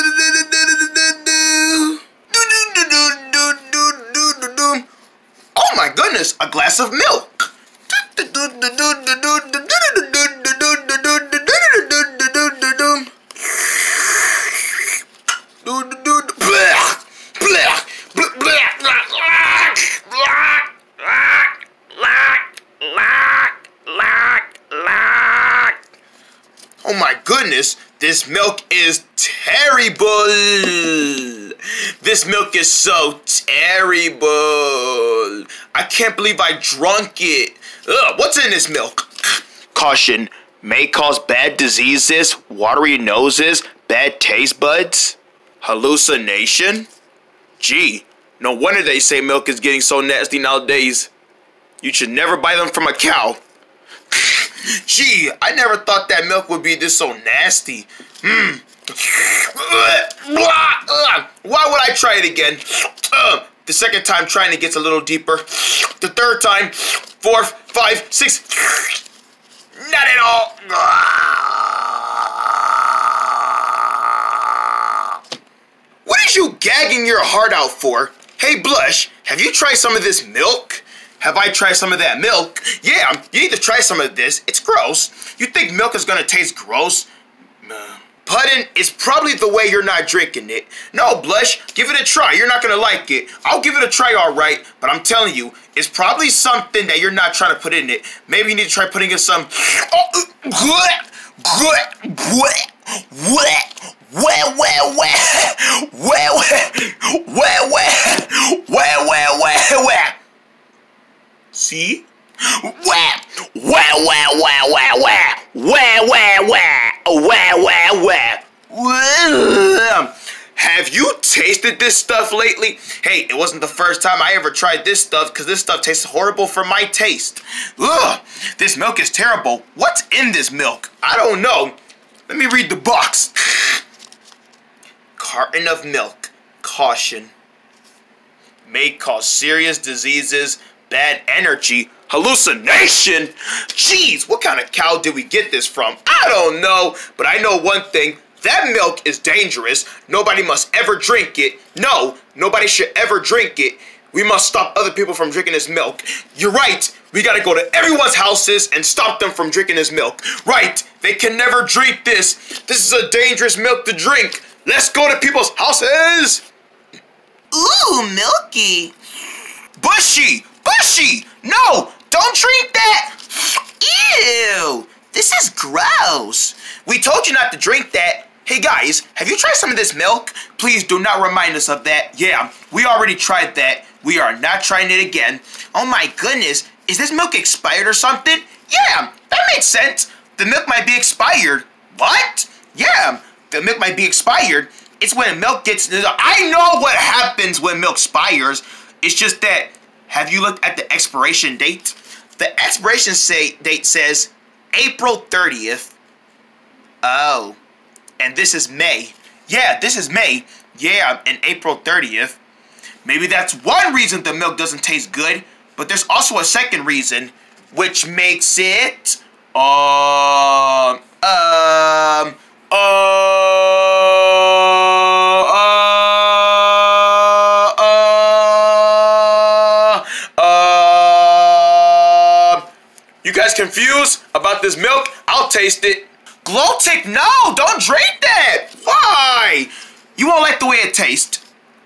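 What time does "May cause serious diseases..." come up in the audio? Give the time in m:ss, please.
2:18.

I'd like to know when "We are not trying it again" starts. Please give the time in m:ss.
3:04.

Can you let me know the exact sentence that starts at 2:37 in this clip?
We gotta go to everyone's houses and stop them from drinking this milk.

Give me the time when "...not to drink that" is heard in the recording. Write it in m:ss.
2:57.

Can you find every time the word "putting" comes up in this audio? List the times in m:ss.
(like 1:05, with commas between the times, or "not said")
1:28, 1:38.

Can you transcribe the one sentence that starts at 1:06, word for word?
The third time, four, five, six.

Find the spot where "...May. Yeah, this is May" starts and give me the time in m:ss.
3:28.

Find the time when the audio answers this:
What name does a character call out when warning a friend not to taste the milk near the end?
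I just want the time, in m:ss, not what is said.
3:56.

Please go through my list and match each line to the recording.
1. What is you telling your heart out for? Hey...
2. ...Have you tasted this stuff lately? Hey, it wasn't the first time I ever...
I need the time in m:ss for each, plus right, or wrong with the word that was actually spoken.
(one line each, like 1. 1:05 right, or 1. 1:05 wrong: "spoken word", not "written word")
1. 1:16 wrong: "gagging", not "telling"
2. 1:58 right.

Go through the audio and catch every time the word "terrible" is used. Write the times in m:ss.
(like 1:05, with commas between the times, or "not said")
0:33, 2:09.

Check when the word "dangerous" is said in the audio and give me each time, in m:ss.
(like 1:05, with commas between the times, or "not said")
2:29, 2:43.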